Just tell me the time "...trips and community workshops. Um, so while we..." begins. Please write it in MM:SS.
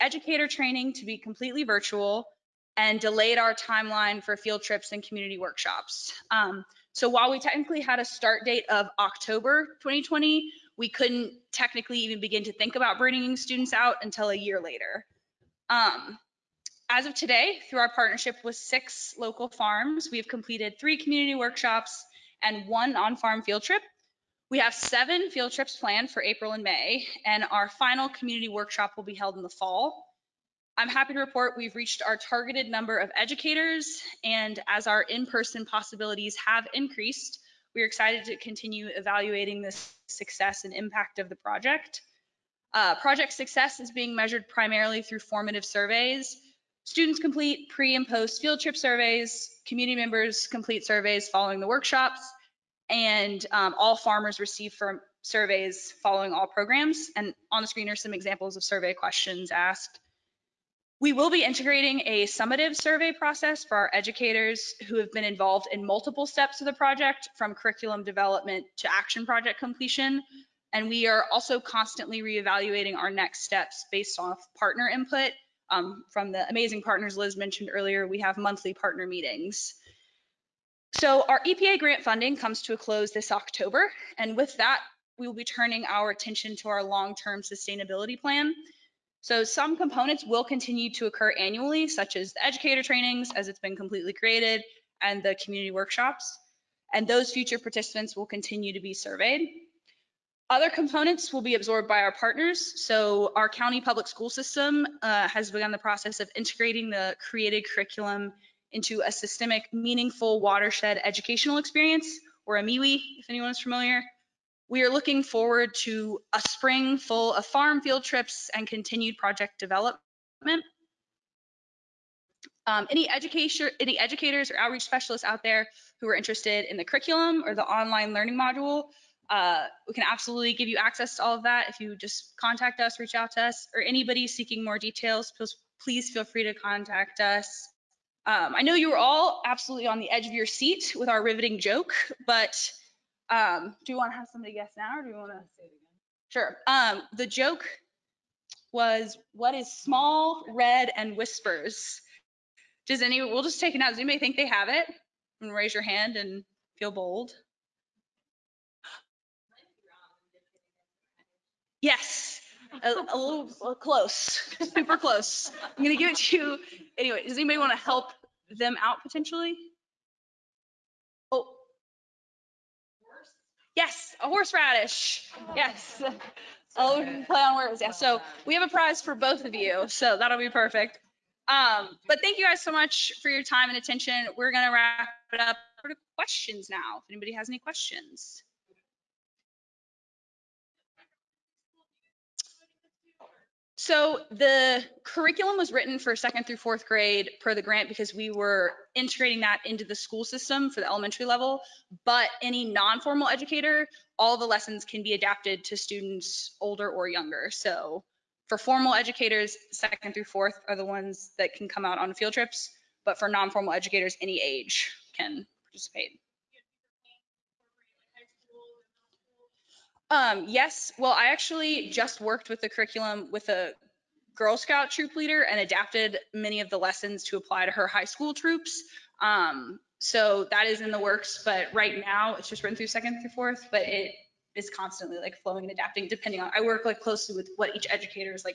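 00:04.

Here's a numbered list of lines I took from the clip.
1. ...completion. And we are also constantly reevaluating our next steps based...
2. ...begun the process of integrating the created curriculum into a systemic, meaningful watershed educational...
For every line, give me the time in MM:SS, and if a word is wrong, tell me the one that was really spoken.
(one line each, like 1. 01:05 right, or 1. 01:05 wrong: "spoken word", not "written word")
1. 01:09 right
2. 01:45 right.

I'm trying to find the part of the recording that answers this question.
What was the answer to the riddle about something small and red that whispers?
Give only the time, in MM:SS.
02:54.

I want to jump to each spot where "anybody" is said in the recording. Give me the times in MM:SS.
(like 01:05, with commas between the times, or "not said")
02:13, 02:33, 02:47, 03:07.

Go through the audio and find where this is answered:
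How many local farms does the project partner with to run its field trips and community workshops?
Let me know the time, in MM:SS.
00:18.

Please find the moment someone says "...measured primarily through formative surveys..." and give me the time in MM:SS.
00:44.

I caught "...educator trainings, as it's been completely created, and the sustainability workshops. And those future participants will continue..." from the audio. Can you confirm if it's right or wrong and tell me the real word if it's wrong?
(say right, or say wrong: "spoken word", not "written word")
wrong: "community", not "sustainability".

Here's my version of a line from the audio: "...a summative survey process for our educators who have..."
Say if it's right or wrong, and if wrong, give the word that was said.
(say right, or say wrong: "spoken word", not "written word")
right.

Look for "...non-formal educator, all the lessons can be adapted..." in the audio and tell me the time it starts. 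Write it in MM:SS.
03:22.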